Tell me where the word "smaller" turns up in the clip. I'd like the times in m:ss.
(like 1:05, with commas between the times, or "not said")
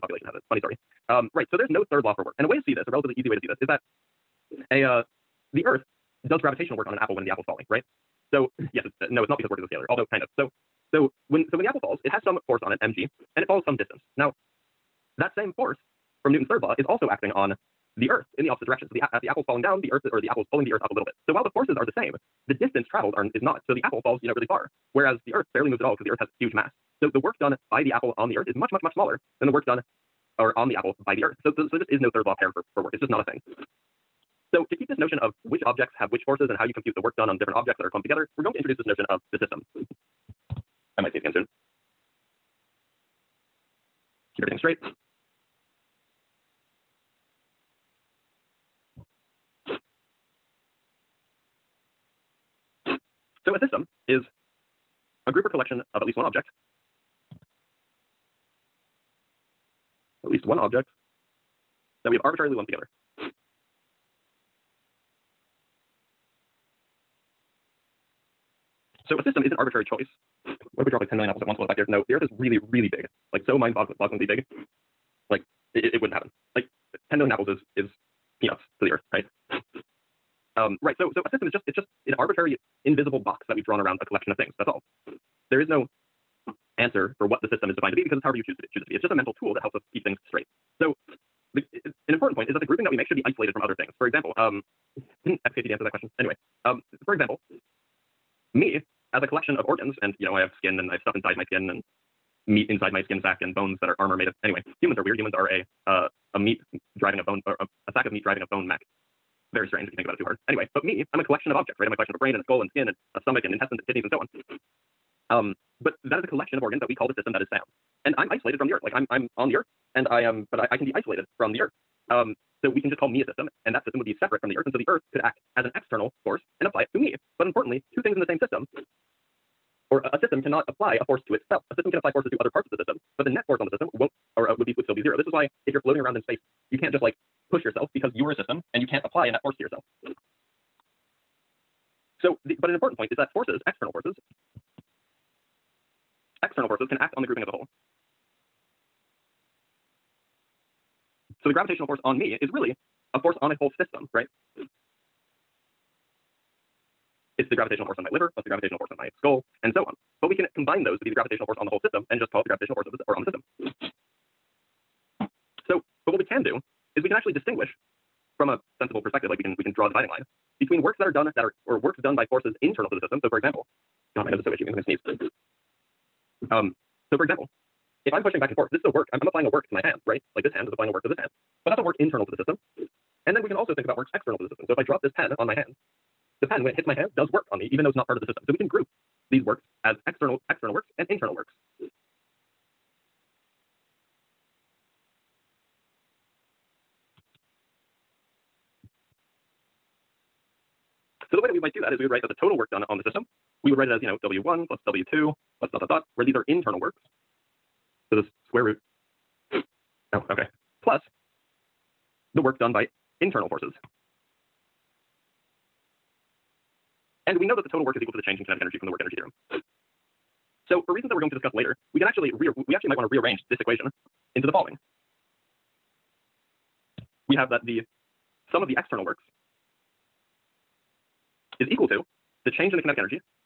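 0:28.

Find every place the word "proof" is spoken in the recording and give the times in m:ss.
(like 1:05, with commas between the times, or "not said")
not said.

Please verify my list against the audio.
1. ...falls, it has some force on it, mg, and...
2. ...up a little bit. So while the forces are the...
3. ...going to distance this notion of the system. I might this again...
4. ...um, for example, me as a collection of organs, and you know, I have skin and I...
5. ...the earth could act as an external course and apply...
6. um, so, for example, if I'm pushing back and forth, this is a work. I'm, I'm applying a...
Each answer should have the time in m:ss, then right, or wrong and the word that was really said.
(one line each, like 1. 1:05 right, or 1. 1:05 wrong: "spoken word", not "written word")
1. 0:11 right
2. 0:20 right
3. 0:38 wrong: "introduce", not "distance"
4. 1:36 right
5. 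2:04 right
6. 2:56 right.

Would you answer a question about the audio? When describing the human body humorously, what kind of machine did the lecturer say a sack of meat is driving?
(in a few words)
a bone mech.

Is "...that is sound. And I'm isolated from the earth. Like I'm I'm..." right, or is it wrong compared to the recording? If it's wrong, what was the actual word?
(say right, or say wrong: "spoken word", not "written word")
right.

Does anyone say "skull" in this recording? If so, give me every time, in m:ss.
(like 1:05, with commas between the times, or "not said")
1:52, 2:39.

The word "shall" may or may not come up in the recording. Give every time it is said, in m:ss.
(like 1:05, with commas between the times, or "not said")
not said.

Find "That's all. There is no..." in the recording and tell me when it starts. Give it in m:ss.
1:24.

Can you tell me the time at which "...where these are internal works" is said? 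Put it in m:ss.
3:26.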